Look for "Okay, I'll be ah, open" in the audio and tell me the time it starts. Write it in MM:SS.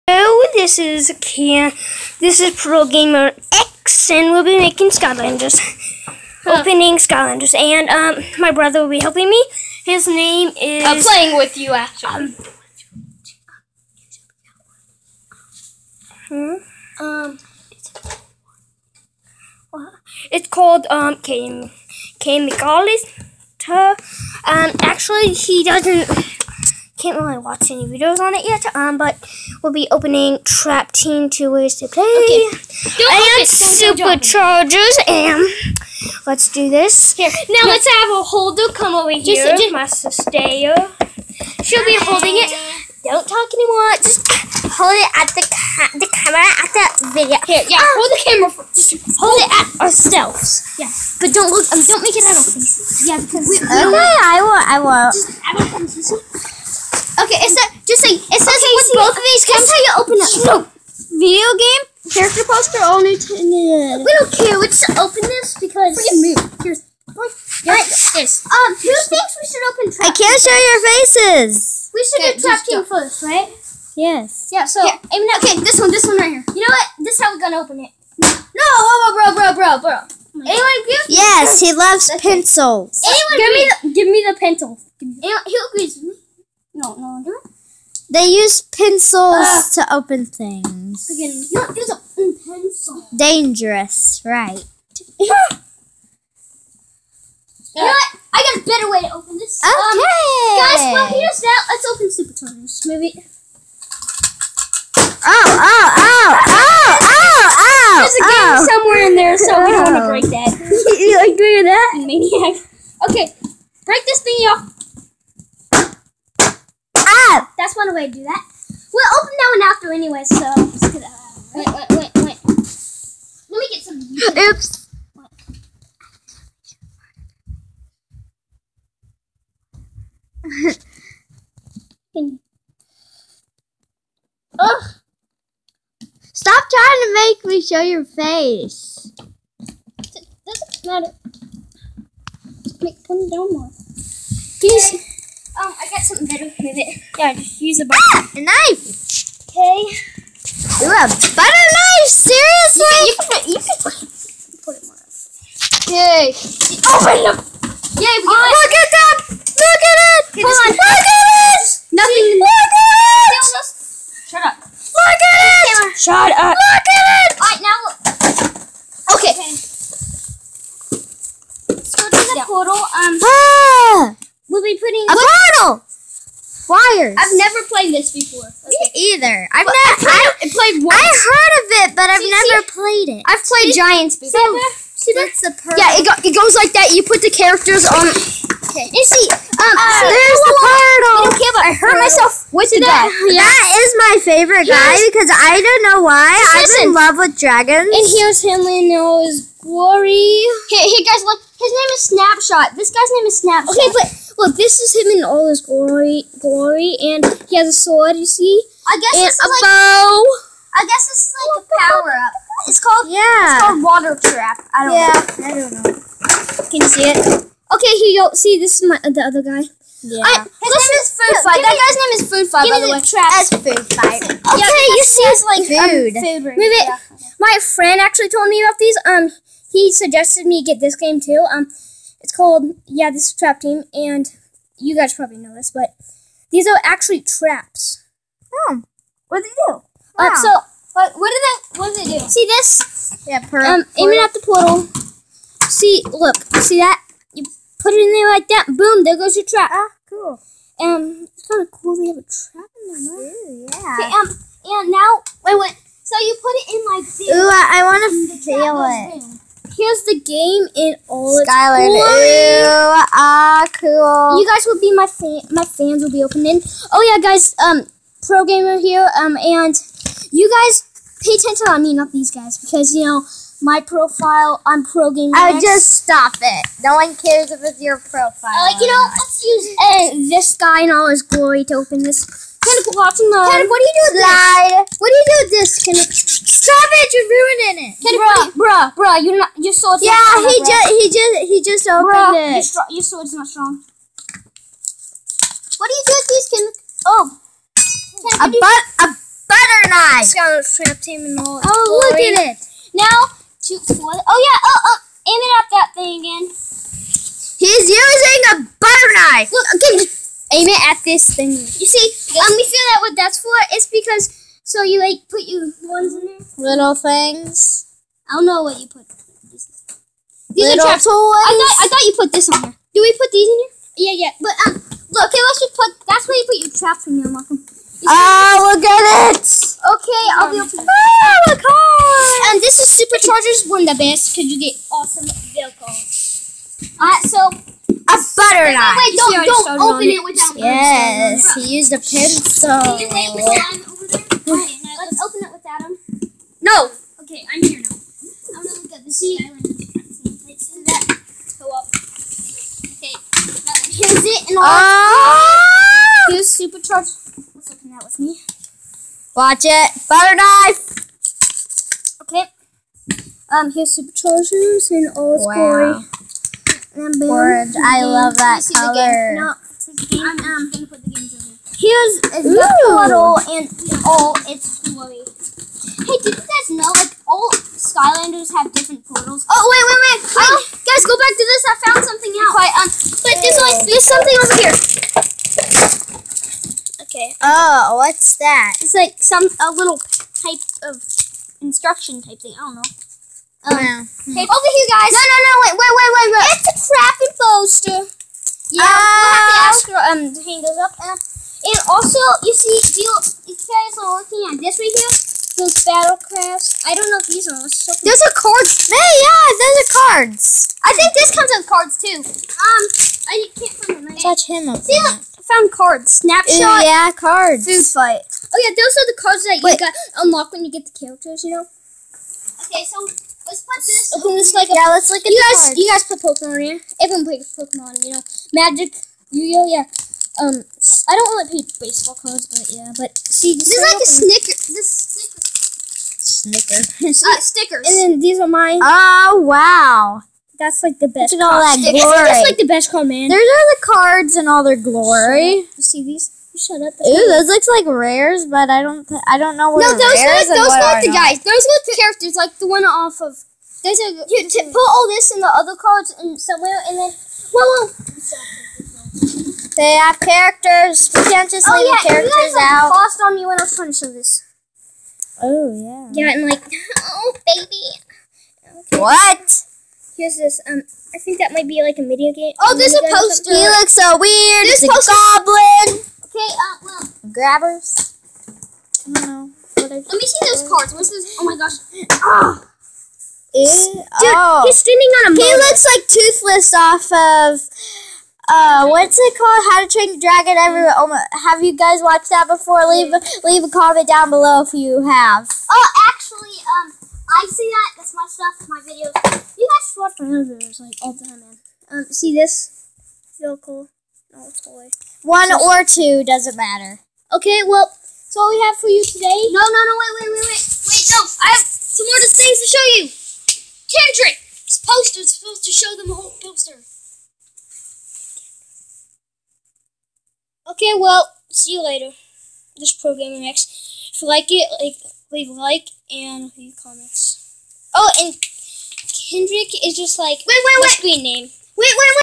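05:29.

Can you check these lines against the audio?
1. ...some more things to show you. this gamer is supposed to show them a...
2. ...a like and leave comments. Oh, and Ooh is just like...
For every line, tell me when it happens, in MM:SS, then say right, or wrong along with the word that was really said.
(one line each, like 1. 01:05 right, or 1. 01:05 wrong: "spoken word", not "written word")
1. 08:31 wrong: "poster", not "gamer"
2. 08:45 wrong: "Kendrick", not "Ooh".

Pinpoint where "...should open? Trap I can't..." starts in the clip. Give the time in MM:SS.
01:09.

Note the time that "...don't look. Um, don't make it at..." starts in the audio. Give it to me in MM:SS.
00:51.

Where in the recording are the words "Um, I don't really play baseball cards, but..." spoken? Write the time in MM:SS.
07:10.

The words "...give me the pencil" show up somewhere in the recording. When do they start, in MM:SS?
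01:23.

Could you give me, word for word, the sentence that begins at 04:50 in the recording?
Yeah, he just, he just, he just opened bruh, it.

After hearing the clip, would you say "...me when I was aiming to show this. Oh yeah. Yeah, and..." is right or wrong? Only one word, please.
wrong.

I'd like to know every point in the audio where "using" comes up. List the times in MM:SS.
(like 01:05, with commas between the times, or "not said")
05:07.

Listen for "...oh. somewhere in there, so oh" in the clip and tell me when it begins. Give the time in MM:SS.
01:48.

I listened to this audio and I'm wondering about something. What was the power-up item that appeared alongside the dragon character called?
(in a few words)
Water trap.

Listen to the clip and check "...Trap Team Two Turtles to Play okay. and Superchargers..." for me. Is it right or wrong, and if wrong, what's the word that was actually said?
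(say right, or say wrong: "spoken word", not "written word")
wrong: "Ways", not "Turtles".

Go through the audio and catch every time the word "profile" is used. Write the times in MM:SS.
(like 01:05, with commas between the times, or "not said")
04:33, 04:37.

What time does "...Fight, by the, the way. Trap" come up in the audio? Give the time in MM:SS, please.
03:42.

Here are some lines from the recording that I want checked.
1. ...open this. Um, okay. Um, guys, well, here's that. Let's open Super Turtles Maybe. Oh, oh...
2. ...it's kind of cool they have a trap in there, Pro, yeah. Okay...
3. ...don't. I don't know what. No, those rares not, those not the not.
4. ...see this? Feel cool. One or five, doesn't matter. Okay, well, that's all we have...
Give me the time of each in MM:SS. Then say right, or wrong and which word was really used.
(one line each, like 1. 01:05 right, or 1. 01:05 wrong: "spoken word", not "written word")
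1. 01:39 right
2. 04:11 wrong: "Ooh", not "Pro"
3. 07:28 right
4. 08:22 wrong: "two", not "five".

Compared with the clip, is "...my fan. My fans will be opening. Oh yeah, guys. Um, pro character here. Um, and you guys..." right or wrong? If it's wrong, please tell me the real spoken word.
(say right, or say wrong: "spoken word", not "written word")
wrong: "gamer", not "character".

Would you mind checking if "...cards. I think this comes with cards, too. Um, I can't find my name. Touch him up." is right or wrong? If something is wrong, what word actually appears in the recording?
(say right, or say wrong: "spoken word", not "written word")
right.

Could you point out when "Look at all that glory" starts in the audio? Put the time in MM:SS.
07:21.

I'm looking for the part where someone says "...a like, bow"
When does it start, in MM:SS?
03:29.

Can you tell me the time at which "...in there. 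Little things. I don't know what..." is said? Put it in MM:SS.
05:16.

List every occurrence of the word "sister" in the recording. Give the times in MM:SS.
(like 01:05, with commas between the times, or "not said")
00:39.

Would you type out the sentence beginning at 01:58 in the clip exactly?
We'll open that one after anyway, so.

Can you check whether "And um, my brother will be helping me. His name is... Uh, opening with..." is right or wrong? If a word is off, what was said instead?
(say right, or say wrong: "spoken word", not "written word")
wrong: "playing", not "opening".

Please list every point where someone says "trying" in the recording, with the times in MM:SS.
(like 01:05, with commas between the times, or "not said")
02:16, 07:43.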